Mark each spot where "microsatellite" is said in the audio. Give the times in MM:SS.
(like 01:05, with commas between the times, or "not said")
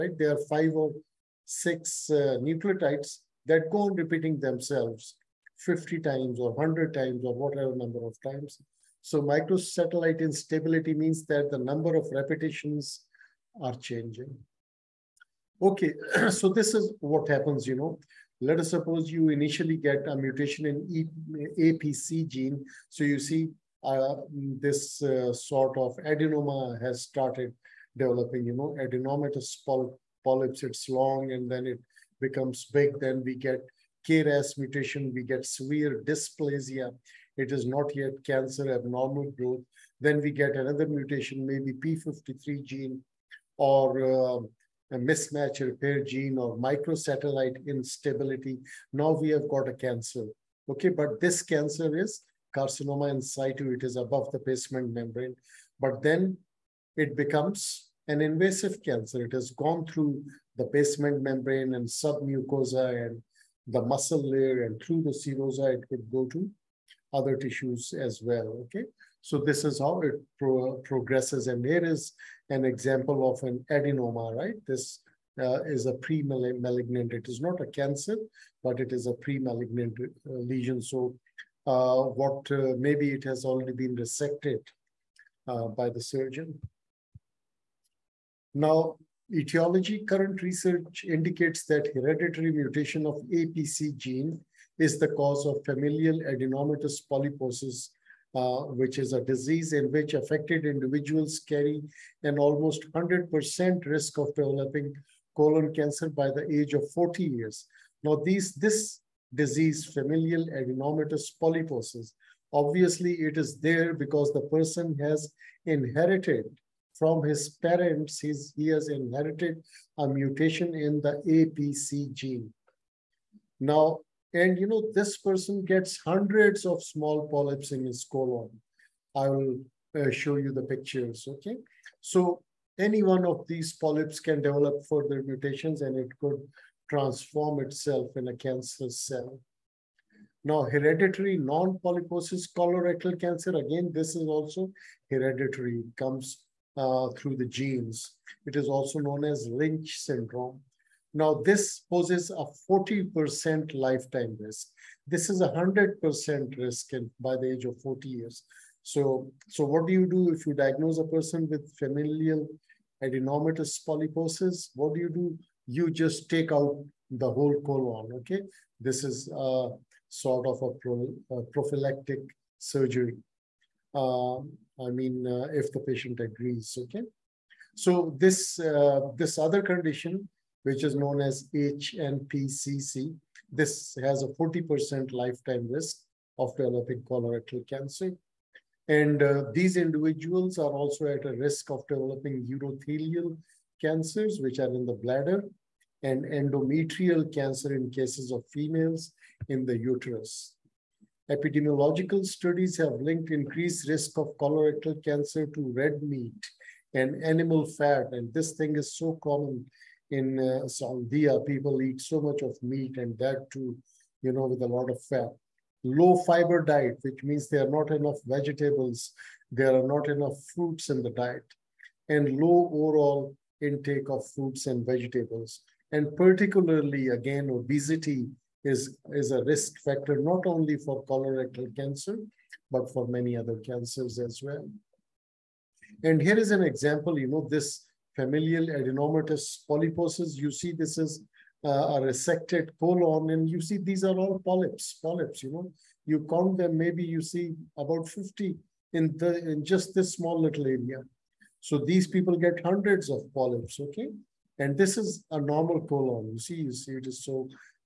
00:09, 00:46.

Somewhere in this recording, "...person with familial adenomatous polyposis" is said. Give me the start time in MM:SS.
02:41.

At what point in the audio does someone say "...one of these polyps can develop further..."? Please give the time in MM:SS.
02:13.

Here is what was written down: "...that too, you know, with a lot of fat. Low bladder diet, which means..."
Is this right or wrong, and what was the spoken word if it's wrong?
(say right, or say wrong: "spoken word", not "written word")
wrong: "fiber", not "bladder".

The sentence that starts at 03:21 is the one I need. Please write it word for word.
Epidemiological studies have linked increased risk of colorectal cancer to red meat and animal fat.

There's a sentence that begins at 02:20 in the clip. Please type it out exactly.
Now, hereditary non-polyposis colorectal cancer, again, this is also hereditary, it comes uh, through the genes.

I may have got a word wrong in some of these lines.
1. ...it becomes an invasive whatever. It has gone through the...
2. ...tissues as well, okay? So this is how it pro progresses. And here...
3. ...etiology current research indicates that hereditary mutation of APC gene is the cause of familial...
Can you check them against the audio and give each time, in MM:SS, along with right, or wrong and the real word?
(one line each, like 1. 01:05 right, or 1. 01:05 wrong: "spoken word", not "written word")
1. 00:56 wrong: "cancer", not "whatever"
2. 01:07 right
3. 01:29 right.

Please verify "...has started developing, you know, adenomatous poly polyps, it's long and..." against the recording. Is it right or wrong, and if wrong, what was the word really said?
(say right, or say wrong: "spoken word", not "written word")
right.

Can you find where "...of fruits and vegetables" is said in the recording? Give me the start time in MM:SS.
03:44.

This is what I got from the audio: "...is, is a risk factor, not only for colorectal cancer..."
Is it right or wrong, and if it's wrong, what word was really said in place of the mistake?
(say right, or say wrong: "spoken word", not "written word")
right.